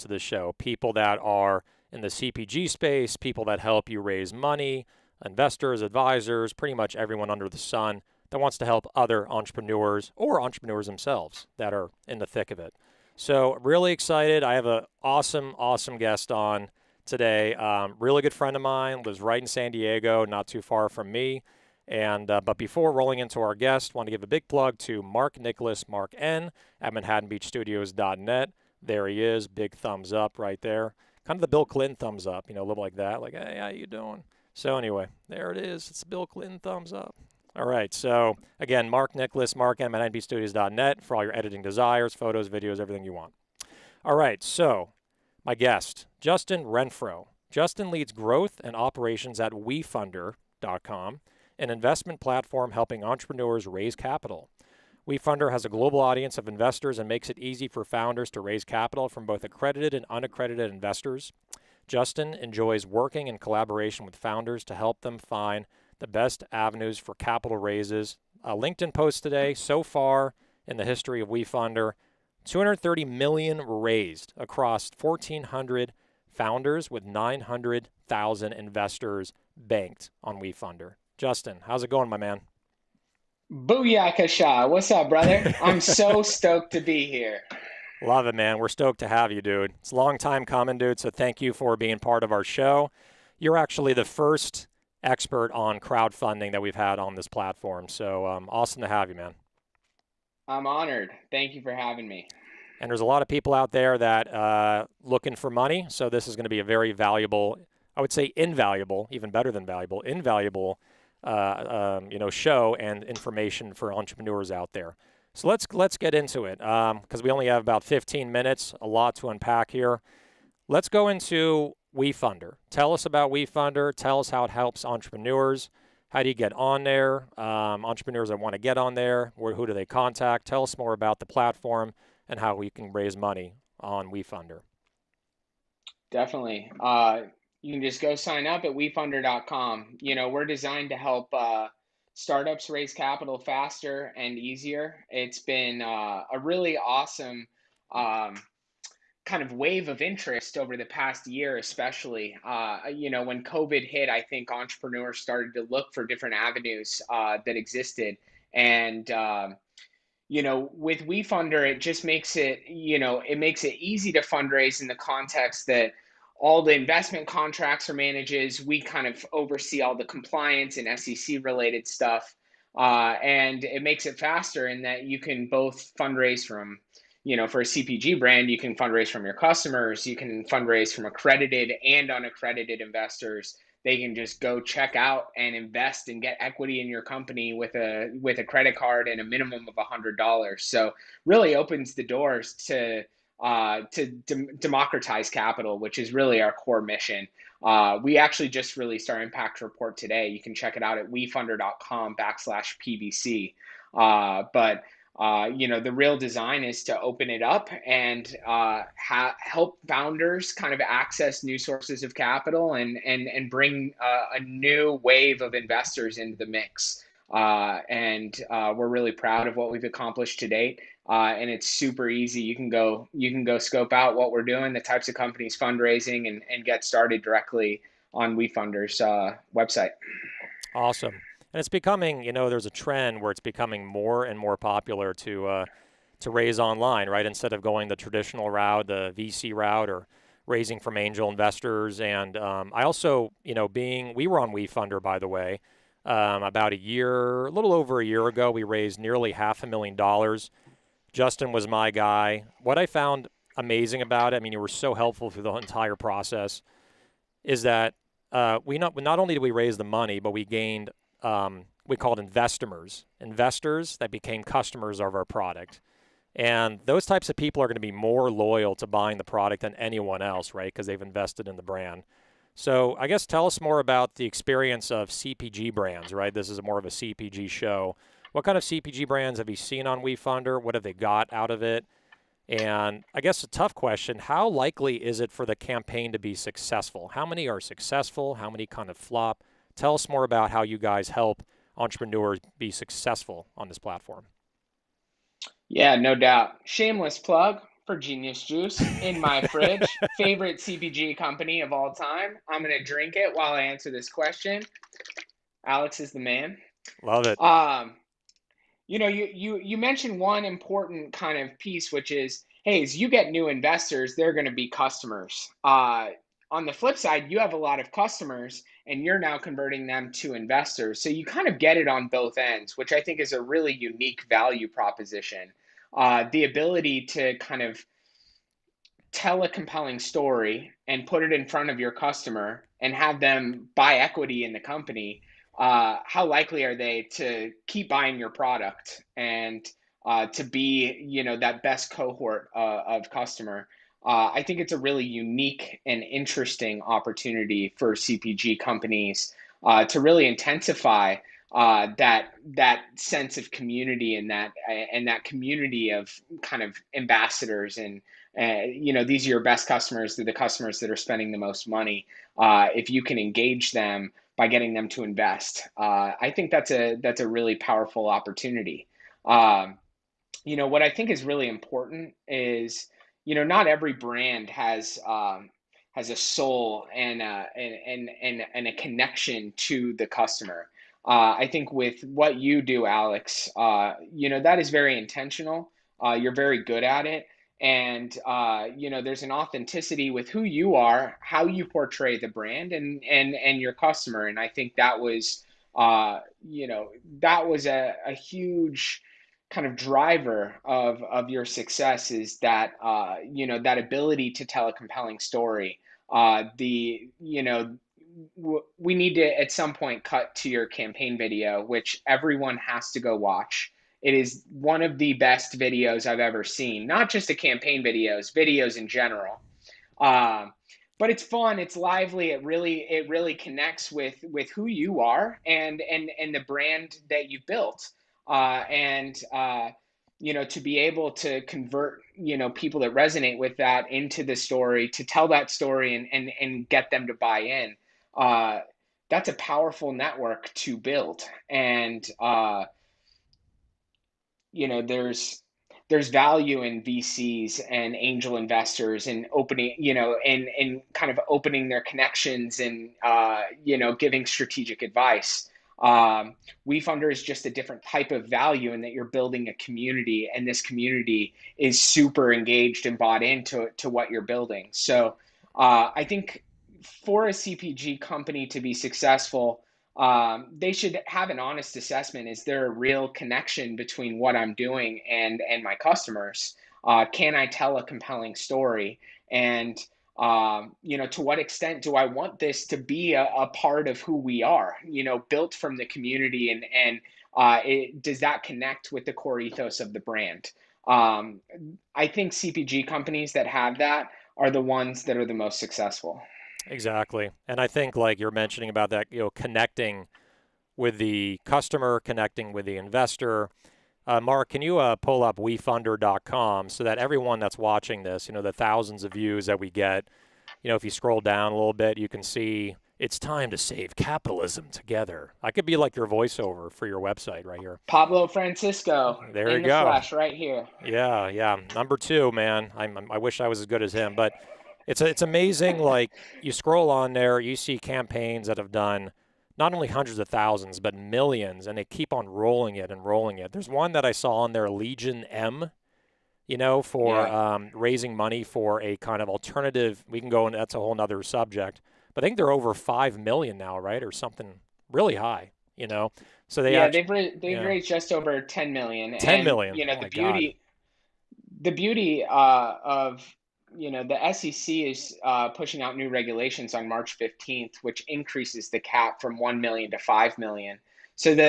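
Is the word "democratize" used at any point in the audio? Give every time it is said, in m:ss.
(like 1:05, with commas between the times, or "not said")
3:14.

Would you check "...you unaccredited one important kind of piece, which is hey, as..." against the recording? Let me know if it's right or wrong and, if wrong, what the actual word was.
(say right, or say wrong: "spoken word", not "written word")
wrong: "mentioned", not "unaccredited".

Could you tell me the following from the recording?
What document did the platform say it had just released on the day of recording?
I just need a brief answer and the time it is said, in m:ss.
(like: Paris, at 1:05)
impact report, at 3:19.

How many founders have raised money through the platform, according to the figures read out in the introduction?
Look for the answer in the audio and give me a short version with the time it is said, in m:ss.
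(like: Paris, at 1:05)
1,400, at 1:14.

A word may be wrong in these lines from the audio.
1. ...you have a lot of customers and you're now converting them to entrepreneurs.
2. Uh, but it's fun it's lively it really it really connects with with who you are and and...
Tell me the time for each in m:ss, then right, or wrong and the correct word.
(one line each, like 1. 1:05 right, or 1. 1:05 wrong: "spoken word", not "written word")
1. 5:17 wrong: "investors", not "entrepreneurs"
2. 7:00 right.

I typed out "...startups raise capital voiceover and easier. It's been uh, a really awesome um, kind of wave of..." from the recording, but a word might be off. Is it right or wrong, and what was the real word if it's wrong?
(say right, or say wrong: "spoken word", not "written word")
wrong: "faster", not "voiceover".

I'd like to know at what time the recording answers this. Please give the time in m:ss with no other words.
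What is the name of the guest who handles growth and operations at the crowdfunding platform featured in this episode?
0:46.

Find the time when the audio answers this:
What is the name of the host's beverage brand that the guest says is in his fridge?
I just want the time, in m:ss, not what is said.
4:57.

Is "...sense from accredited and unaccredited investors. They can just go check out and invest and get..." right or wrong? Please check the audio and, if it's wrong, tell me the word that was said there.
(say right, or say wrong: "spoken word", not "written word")
wrong: "fundraise", not "sense".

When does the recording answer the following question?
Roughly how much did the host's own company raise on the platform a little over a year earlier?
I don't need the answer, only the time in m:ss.
4:08.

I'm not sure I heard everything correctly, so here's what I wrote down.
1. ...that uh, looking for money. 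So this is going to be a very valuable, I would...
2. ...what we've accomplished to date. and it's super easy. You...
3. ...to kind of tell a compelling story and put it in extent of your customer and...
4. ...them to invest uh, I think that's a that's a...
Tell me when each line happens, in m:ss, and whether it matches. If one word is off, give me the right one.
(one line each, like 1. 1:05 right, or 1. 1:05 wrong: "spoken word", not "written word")
1. 1:43 right
2. 3:39 right
3. 5:27 wrong: "front", not "extent"
4. 6:04 right.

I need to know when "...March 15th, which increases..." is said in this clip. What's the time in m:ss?
9:16.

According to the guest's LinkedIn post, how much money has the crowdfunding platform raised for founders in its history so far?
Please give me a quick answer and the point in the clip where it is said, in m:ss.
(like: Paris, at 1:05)
230 million, at 1:12.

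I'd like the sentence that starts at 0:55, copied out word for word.
WeFunder has a global audience of investors and makes it easy for founders to raise capital from both accredited and unaccredited investors.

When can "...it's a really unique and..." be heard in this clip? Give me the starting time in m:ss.
5:44.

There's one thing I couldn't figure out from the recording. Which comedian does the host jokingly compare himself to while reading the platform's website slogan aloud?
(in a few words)
Pablo Francisco.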